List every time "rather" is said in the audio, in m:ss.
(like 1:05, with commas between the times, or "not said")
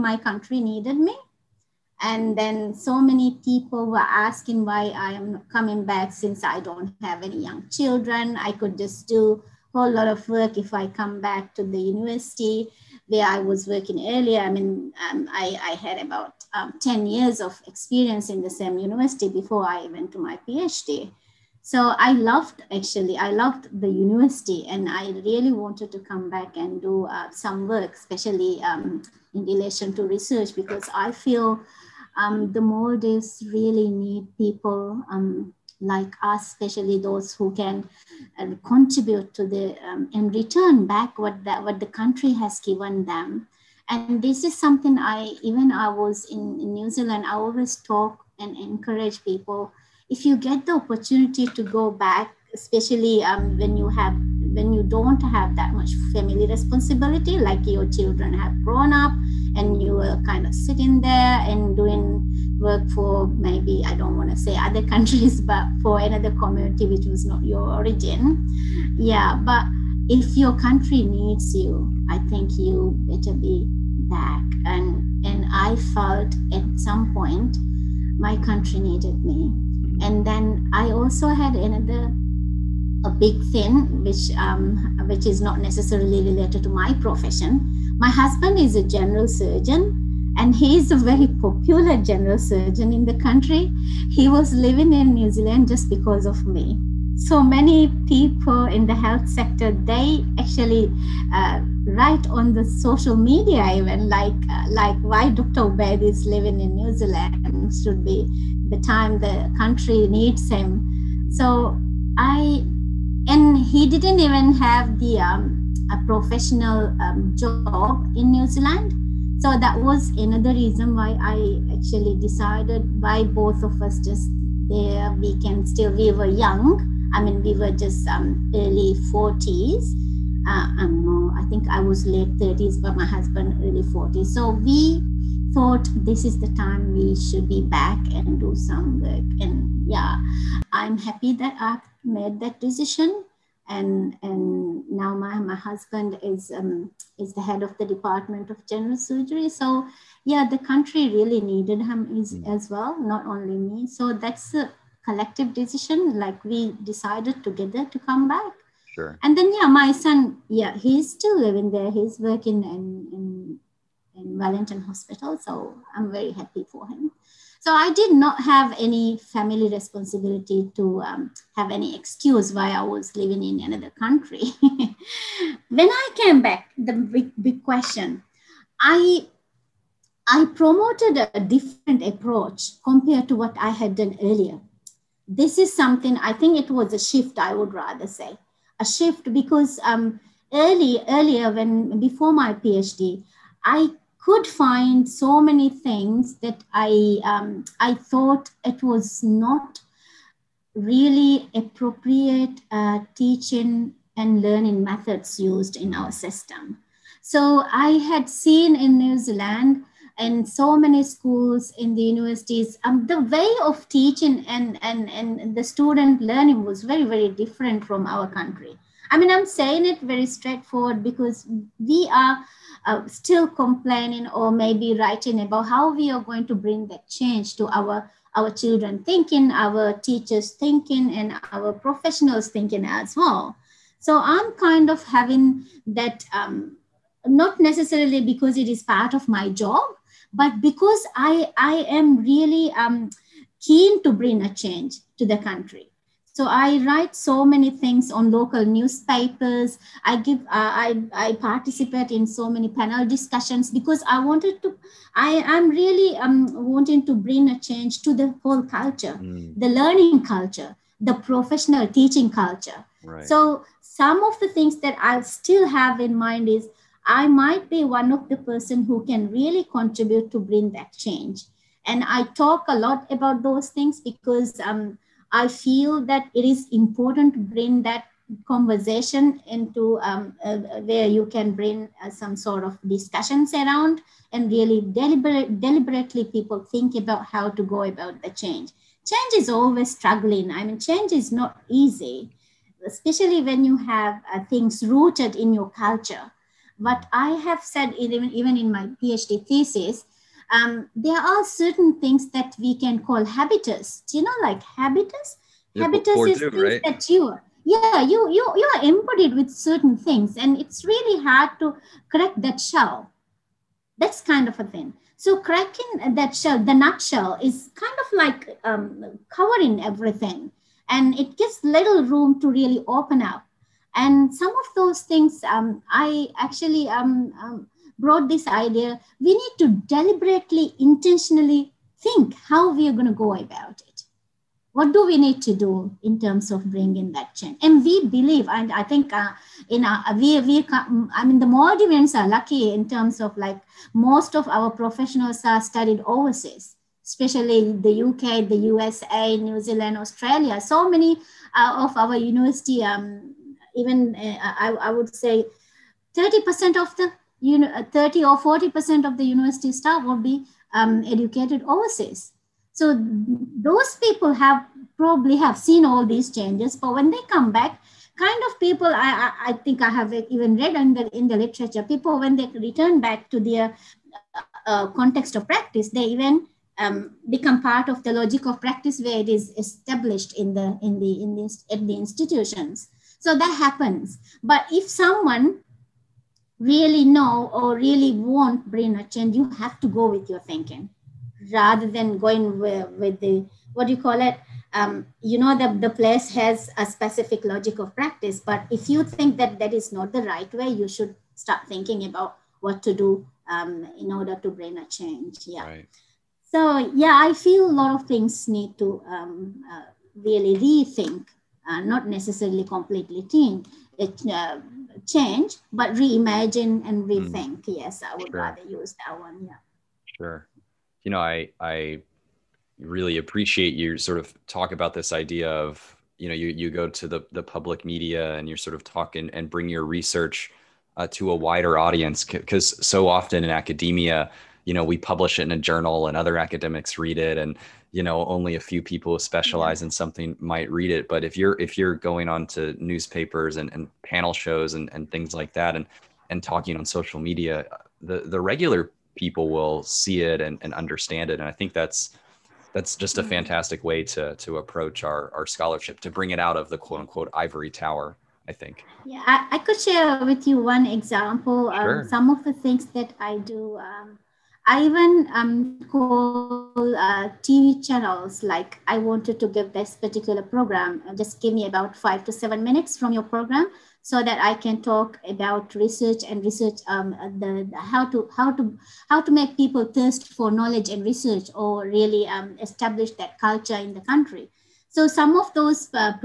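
3:07, 6:31, 6:58.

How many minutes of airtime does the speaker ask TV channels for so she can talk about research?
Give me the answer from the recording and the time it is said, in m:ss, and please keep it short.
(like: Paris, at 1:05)
5 to 7 minutes, at 7:51.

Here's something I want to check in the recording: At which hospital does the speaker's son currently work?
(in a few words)
Wellington Hospital.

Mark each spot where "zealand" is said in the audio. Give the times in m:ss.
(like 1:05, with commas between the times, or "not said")
0:46, 1:35, 1:46, 1:58, 3:29, 5:49.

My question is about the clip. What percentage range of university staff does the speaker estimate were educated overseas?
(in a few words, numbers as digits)
30 or 40%.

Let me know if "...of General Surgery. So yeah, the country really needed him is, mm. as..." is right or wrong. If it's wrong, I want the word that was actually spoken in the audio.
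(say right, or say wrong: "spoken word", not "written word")
right.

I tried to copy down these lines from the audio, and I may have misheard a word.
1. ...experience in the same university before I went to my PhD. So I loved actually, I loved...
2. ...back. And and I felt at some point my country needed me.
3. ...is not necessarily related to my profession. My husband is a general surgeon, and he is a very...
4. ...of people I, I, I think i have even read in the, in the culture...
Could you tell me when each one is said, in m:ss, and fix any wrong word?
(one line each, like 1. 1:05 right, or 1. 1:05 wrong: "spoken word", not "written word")
1. 0:17 right
2. 1:13 right
3. 1:25 right
4. 6:08 wrong: "literature", not "culture".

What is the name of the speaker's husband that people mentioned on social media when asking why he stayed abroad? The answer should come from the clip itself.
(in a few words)
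Dr Ubaid.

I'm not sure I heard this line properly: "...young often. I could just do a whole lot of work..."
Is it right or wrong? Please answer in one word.
wrong.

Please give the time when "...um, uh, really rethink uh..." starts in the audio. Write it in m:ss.
6:49.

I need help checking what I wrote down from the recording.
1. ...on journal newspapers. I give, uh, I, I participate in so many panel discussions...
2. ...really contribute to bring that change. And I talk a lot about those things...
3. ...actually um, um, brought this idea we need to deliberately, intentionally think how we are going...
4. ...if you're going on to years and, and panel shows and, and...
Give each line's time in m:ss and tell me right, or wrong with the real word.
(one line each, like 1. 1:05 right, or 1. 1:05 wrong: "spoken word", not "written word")
1. 4:08 wrong: "local", not "journal"
2. 4:29 right
3. 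5:26 right
4. 7:21 wrong: "newspapers", not "years".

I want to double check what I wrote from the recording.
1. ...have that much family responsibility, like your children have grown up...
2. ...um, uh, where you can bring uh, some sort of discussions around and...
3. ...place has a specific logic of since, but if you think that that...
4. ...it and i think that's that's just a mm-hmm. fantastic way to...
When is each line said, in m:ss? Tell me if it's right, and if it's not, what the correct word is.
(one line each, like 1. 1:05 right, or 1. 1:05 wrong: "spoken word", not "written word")
1. 0:55 right
2. 4:40 right
3. 6:35 wrong: "practice", not "since"
4. 7:31 right.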